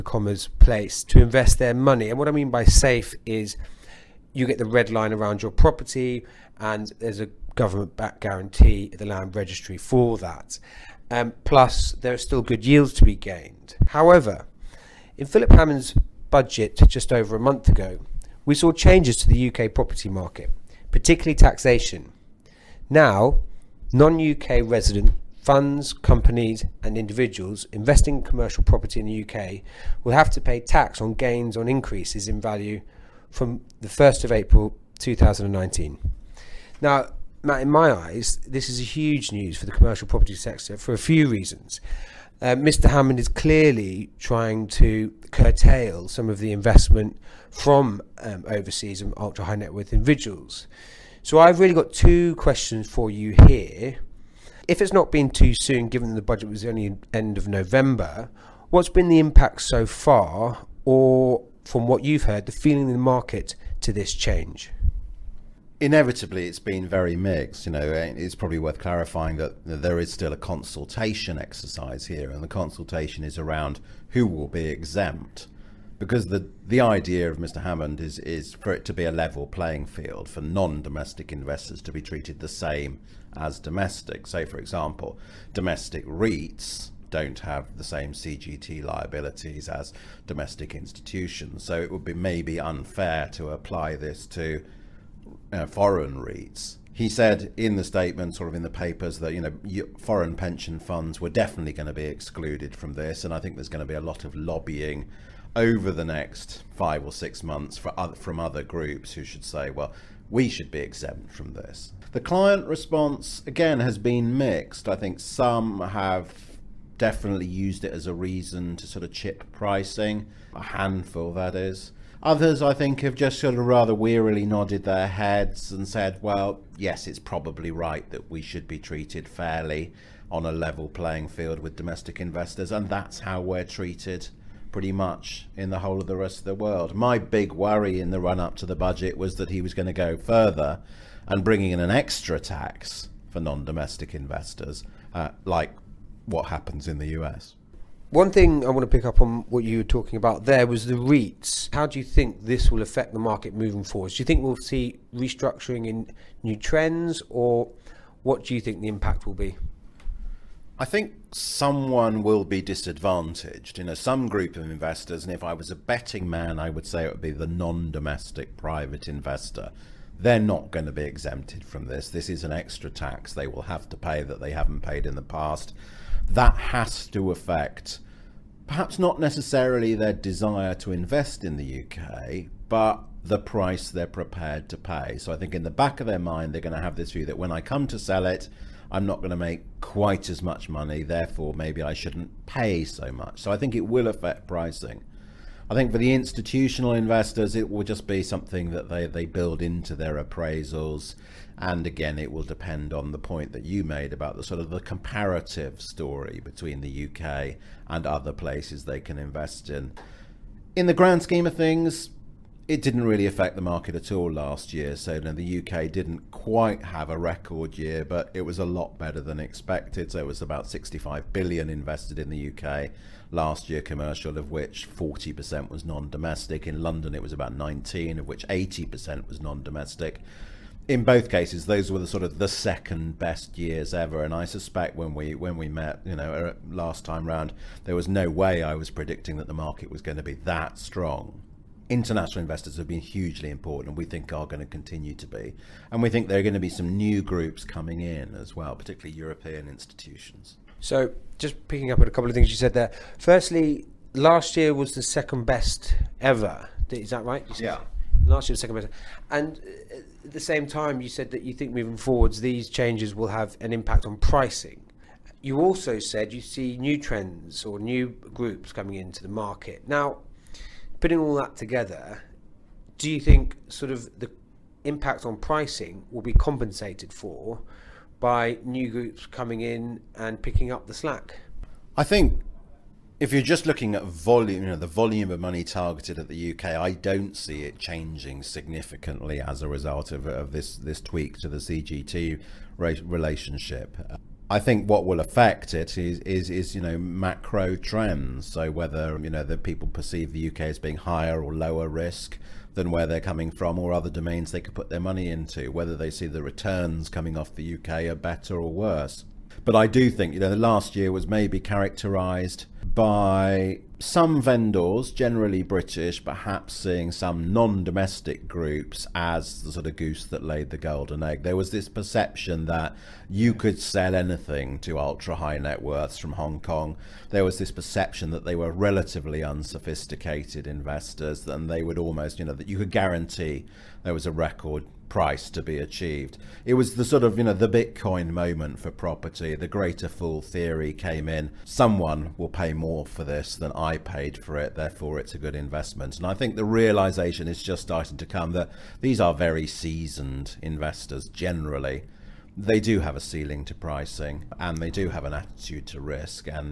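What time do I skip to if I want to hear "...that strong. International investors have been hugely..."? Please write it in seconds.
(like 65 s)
240 s.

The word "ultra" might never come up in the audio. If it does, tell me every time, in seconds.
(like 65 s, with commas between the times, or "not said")
49 s, 324 s.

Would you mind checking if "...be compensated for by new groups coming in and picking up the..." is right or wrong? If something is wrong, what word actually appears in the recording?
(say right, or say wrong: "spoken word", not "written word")
right.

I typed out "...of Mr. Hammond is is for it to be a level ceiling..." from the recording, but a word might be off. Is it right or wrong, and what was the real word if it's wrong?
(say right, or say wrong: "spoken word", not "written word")
wrong: "playing", not "ceiling".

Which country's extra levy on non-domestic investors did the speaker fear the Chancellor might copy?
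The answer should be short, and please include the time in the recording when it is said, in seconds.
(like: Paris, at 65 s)
US, at 147 s.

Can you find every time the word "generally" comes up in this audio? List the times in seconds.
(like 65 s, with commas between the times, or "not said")
315 s, 351 s.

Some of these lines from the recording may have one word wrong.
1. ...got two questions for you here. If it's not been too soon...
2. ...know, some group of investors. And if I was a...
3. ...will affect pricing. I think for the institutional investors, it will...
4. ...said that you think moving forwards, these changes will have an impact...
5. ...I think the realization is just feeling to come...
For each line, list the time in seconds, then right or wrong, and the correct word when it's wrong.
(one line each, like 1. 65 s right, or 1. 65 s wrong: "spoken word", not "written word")
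1. 51 s right
2. 163 s right
3. 193 s right
4. 261 s right
5. 346 s wrong: "starting", not "feeling".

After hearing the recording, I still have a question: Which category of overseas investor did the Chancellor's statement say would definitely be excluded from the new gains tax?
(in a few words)
foreign pension funds.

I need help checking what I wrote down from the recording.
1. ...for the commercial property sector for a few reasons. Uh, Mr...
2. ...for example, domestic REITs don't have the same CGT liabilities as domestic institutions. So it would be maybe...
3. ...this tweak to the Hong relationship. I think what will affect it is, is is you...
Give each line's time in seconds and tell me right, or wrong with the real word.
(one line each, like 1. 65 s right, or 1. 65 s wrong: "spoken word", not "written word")
1. 39 s right
2. 84 s right
3. 290 s wrong: "CGT", not "Hong".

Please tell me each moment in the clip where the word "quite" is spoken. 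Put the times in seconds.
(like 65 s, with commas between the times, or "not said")
189 s, 216 s.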